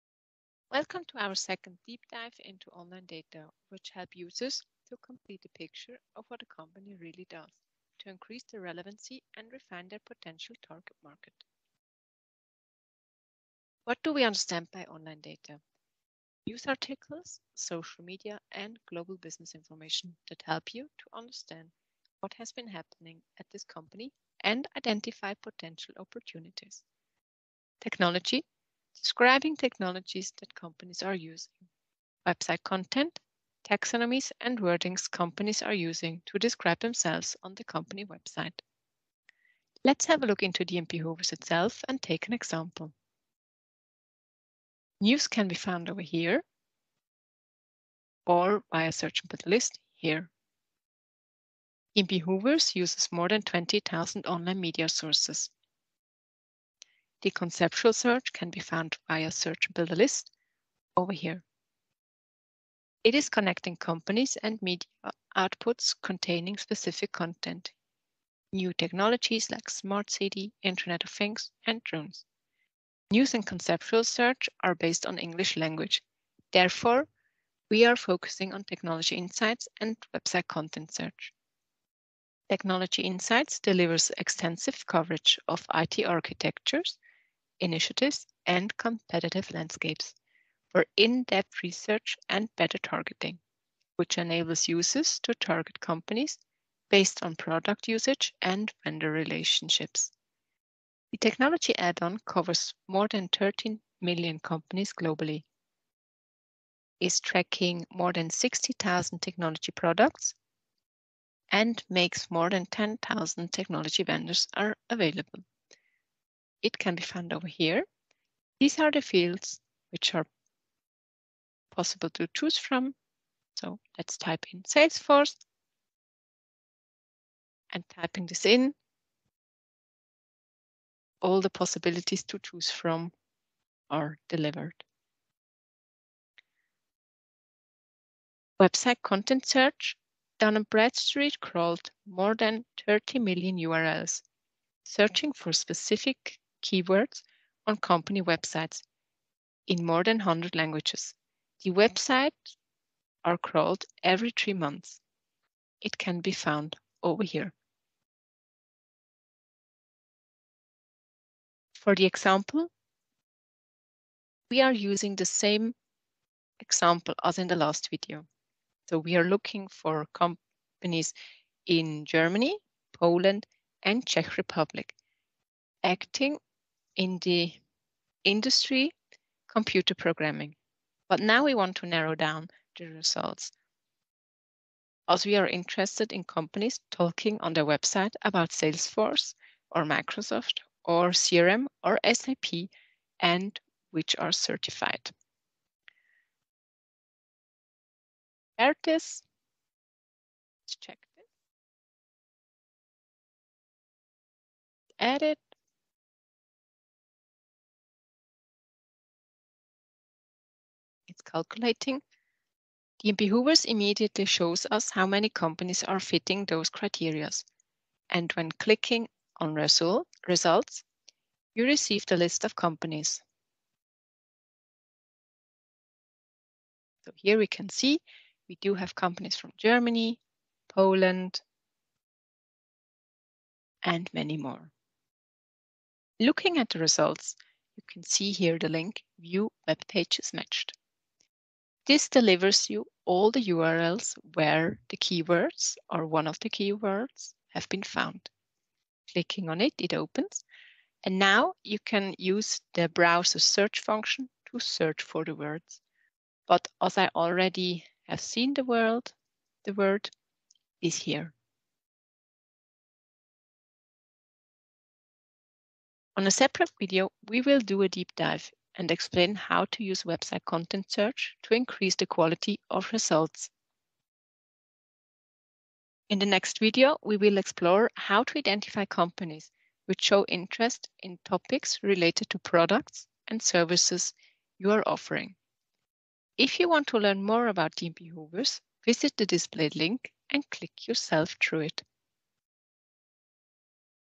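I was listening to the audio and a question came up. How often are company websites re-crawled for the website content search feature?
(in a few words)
Every three months.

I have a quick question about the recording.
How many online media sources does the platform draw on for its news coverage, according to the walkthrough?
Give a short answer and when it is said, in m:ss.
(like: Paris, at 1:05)
20,000, at 0:53.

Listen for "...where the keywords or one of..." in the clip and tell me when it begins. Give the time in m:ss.
4:04.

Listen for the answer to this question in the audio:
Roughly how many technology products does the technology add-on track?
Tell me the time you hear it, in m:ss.
1:48.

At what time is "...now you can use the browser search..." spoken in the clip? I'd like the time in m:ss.
4:11.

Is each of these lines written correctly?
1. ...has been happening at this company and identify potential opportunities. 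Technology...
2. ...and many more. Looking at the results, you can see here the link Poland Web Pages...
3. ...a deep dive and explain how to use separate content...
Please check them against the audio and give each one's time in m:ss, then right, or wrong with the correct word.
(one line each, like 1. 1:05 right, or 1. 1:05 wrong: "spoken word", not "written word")
1. 0:22 right
2. 3:53 wrong: "View", not "Poland"
3. 4:27 wrong: "website", not "separate".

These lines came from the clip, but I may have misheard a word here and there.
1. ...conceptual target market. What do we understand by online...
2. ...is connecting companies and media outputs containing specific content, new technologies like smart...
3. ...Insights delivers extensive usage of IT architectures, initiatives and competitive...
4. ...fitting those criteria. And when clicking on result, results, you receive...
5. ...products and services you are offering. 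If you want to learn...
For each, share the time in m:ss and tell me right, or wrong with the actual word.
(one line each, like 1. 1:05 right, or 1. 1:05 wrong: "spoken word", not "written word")
1. 0:10 wrong: "potential", not "conceptual"
2. 1:03 right
3. 1:23 wrong: "coverage", not "usage"
4. 3:35 right
5. 4:42 right.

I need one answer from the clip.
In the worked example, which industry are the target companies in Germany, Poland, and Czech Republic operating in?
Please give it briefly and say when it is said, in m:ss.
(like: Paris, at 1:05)
Computer programming, at 2:59.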